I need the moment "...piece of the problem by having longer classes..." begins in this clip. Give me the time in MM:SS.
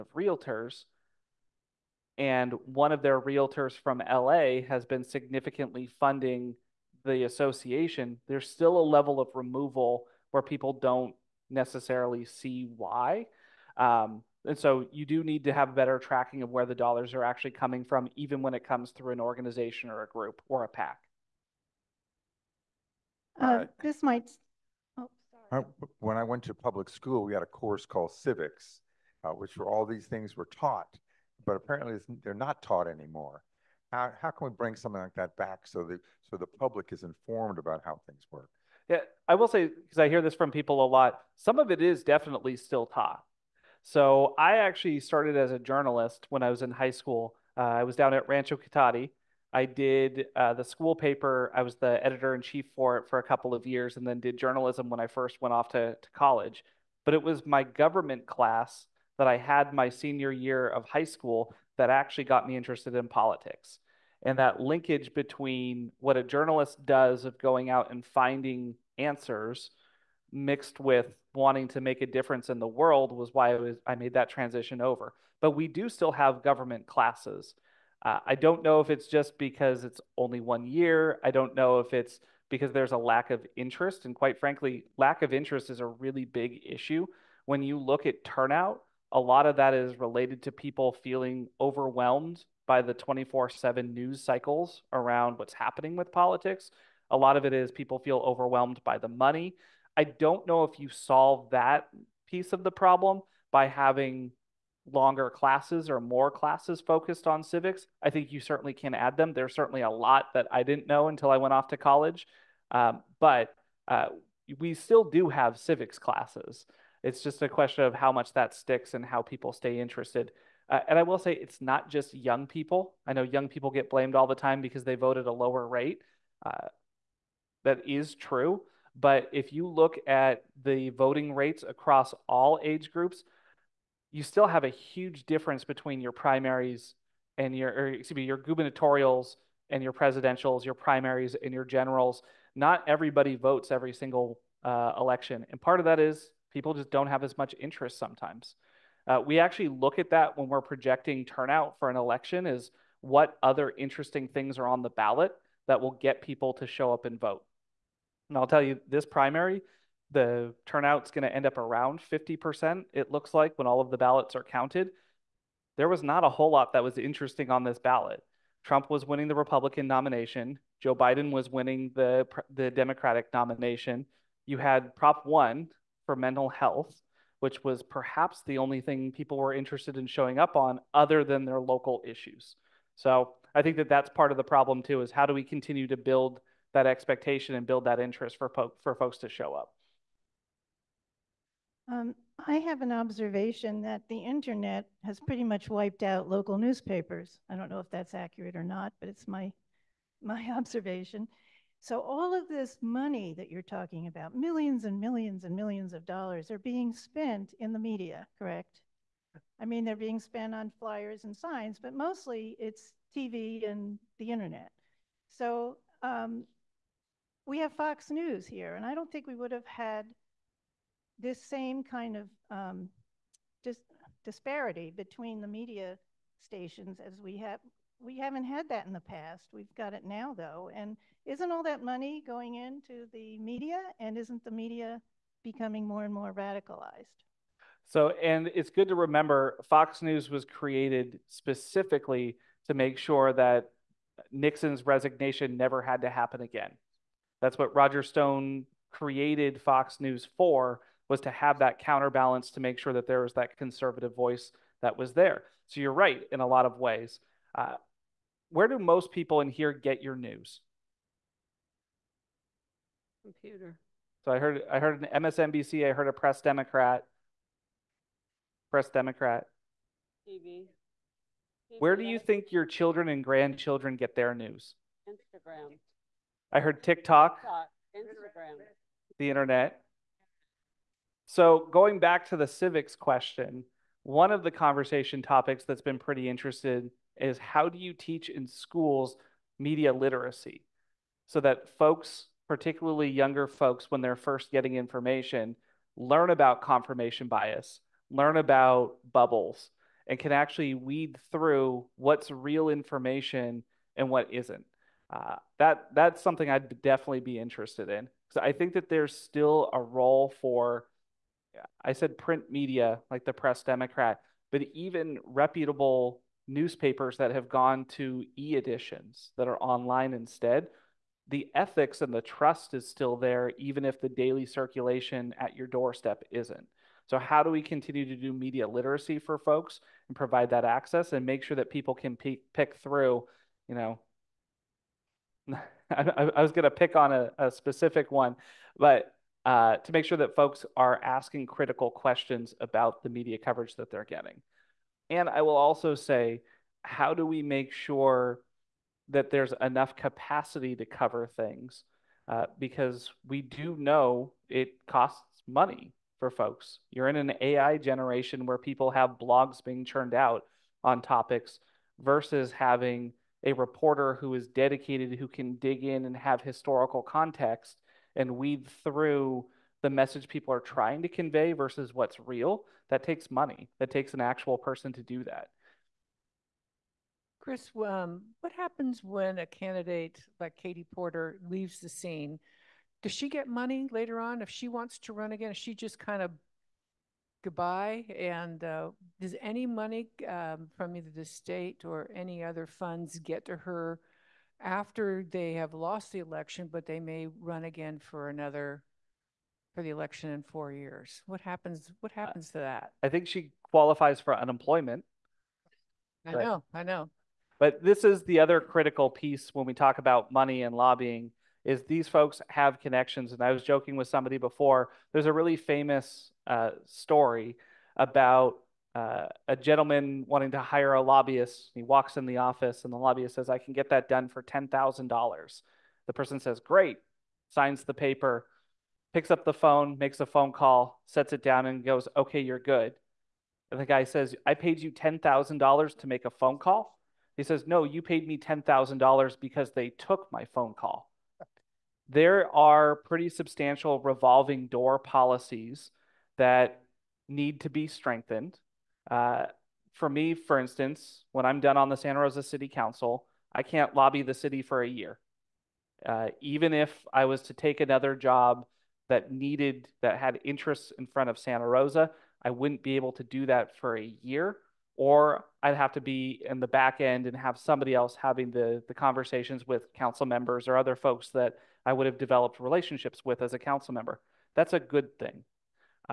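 01:42.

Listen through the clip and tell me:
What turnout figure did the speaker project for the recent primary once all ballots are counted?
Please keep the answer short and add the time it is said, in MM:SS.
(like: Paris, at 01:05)
50%, at 02:42.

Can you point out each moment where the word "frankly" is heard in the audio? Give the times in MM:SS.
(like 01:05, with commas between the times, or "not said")
01:24.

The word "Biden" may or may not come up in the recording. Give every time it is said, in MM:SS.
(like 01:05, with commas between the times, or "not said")
02:50.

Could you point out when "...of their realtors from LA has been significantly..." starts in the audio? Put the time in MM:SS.
00:02.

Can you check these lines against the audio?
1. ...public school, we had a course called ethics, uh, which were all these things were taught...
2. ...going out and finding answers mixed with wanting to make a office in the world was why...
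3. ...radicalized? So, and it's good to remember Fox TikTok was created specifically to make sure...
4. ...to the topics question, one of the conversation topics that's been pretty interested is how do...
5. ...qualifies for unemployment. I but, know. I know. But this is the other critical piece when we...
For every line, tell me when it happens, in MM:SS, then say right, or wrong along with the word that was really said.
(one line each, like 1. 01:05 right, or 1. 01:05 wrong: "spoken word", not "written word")
1. 00:26 wrong: "civics", not "ethics"
2. 01:07 wrong: "difference", not "office"
3. 03:56 wrong: "News", not "TikTok"
4. 04:42 wrong: "civics", not "topics"
5. 06:43 right.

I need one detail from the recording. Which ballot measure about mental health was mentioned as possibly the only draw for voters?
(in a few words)
Prop 1.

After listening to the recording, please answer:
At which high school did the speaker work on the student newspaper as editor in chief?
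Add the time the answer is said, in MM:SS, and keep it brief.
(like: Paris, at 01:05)
Rancho Cotati, at 00:48.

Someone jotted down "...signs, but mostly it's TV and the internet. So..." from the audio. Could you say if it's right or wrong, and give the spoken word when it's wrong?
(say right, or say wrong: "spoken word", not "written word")
right.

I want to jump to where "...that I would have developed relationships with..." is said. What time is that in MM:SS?
07:51.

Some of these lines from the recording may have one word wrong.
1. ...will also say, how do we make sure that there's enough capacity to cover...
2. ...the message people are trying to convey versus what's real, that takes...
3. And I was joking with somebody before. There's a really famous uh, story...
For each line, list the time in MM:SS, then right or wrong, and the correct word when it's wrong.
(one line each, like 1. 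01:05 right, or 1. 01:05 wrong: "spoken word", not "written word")
1. 05:45 right
2. 06:09 right
3. 06:53 right.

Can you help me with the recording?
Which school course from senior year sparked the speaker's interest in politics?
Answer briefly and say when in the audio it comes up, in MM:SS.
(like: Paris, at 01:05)
government class, at 00:57.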